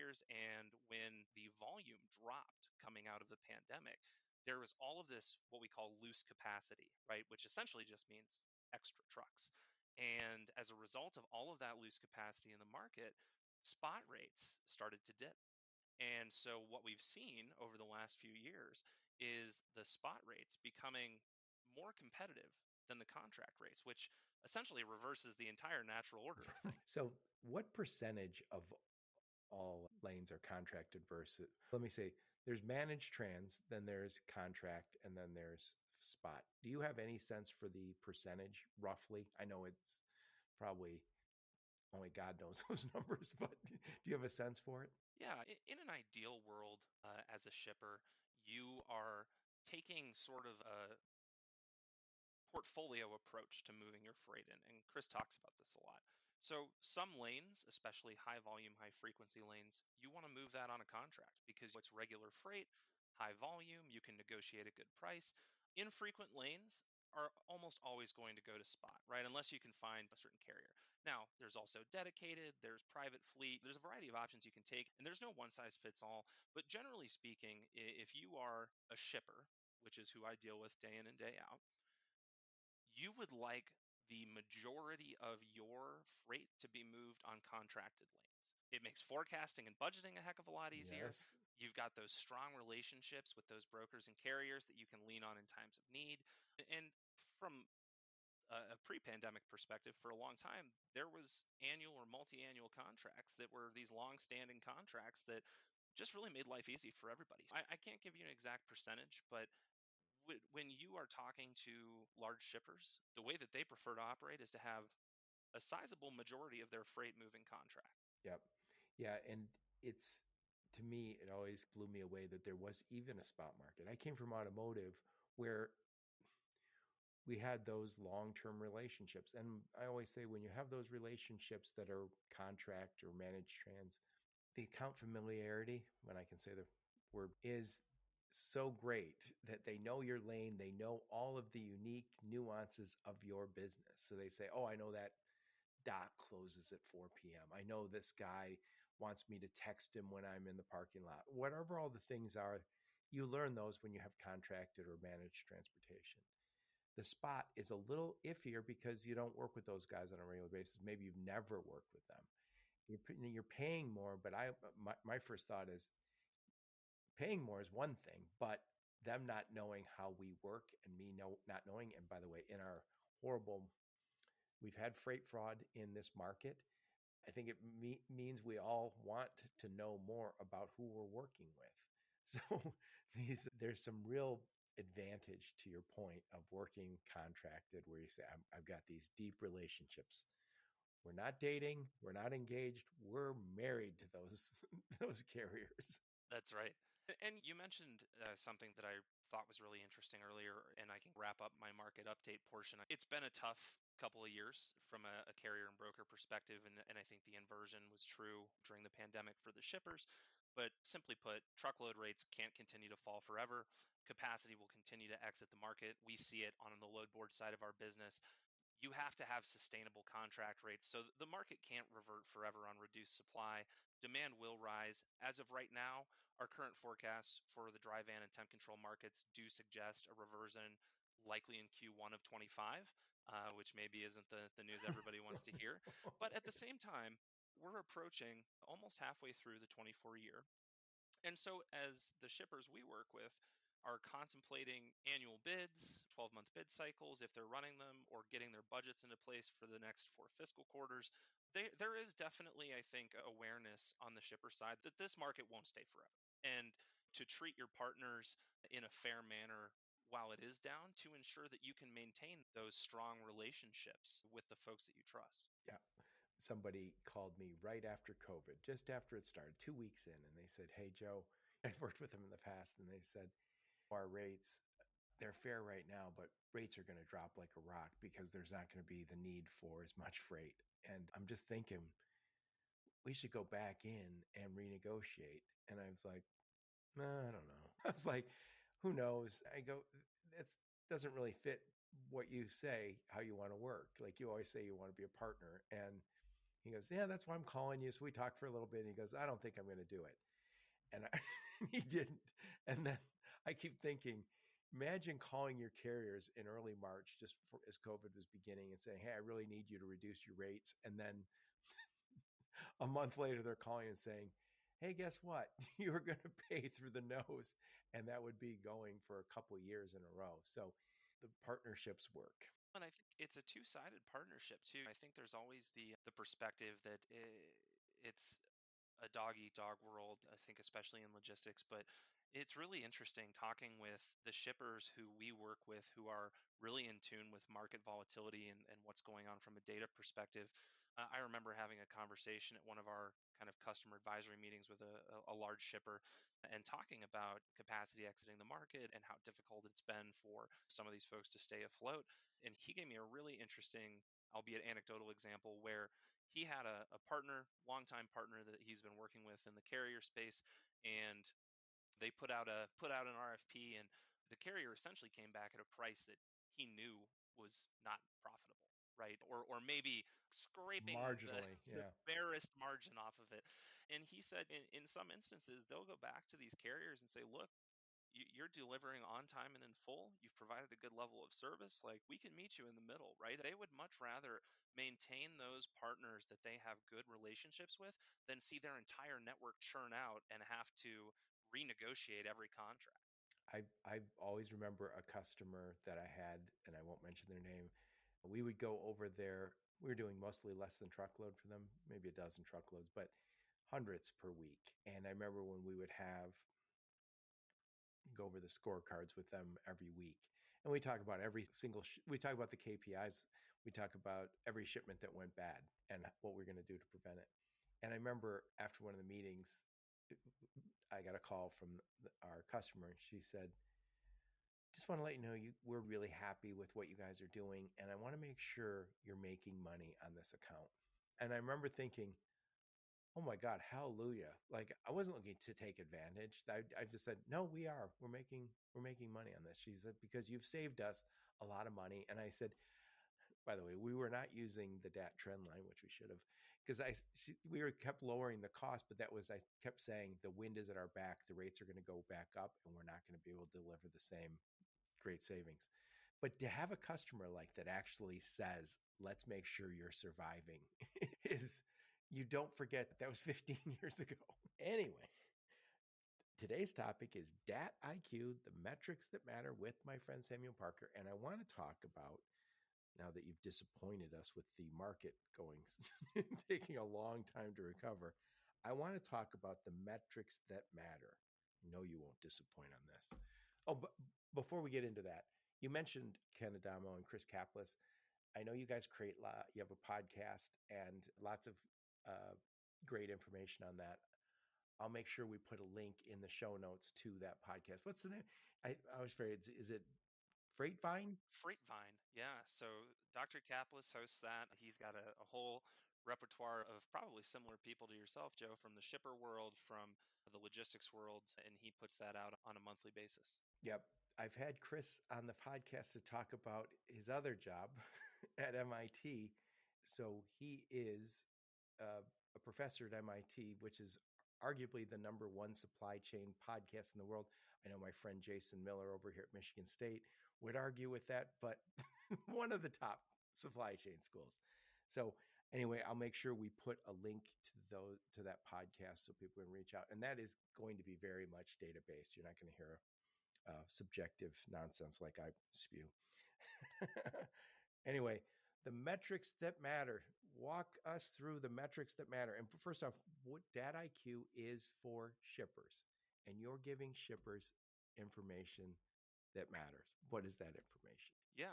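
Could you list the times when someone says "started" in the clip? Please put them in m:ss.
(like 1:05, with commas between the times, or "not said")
0:14, 4:29.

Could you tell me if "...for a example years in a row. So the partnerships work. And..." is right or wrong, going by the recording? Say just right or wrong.
wrong.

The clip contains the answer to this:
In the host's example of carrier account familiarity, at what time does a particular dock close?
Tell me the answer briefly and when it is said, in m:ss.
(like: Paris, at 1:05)
4 p.m., at 2:26.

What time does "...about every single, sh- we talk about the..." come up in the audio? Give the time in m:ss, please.
6:51.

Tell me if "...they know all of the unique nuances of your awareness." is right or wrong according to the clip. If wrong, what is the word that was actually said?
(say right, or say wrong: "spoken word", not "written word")
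wrong: "business", not "awareness".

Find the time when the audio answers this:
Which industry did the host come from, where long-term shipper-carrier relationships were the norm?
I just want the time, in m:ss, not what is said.
2:04.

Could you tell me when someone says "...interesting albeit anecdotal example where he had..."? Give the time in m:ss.
5:53.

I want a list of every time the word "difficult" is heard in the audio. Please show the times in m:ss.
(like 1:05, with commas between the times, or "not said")
5:49.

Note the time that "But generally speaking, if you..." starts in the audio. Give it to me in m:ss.
1:16.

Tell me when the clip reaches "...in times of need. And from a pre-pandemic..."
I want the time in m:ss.
1:35.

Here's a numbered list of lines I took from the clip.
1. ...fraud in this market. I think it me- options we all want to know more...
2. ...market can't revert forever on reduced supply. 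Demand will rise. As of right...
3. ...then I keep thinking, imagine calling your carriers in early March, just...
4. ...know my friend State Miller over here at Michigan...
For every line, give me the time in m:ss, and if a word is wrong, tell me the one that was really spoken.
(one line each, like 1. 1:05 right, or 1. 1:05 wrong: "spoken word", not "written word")
1. 2:55 wrong: "means", not "options"
2. 3:41 right
3. 5:02 right
4. 8:47 wrong: "Jason", not "State".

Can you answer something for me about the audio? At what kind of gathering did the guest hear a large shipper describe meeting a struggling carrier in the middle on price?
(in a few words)
customer advisory meetings.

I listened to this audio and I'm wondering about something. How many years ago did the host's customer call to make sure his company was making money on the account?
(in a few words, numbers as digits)
15.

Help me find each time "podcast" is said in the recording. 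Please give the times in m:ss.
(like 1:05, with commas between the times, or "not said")
8:09, 8:17, 8:35, 8:46, 8:58.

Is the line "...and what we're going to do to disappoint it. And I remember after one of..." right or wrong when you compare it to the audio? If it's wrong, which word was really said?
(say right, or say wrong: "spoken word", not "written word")
wrong: "prevent", not "disappoint".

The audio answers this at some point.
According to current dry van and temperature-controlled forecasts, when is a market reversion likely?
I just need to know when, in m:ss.
3:51.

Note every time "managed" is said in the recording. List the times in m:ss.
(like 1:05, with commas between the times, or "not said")
0:32, 2:13, 2:34.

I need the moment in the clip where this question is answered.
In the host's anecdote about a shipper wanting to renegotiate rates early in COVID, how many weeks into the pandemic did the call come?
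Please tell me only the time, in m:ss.
4:29.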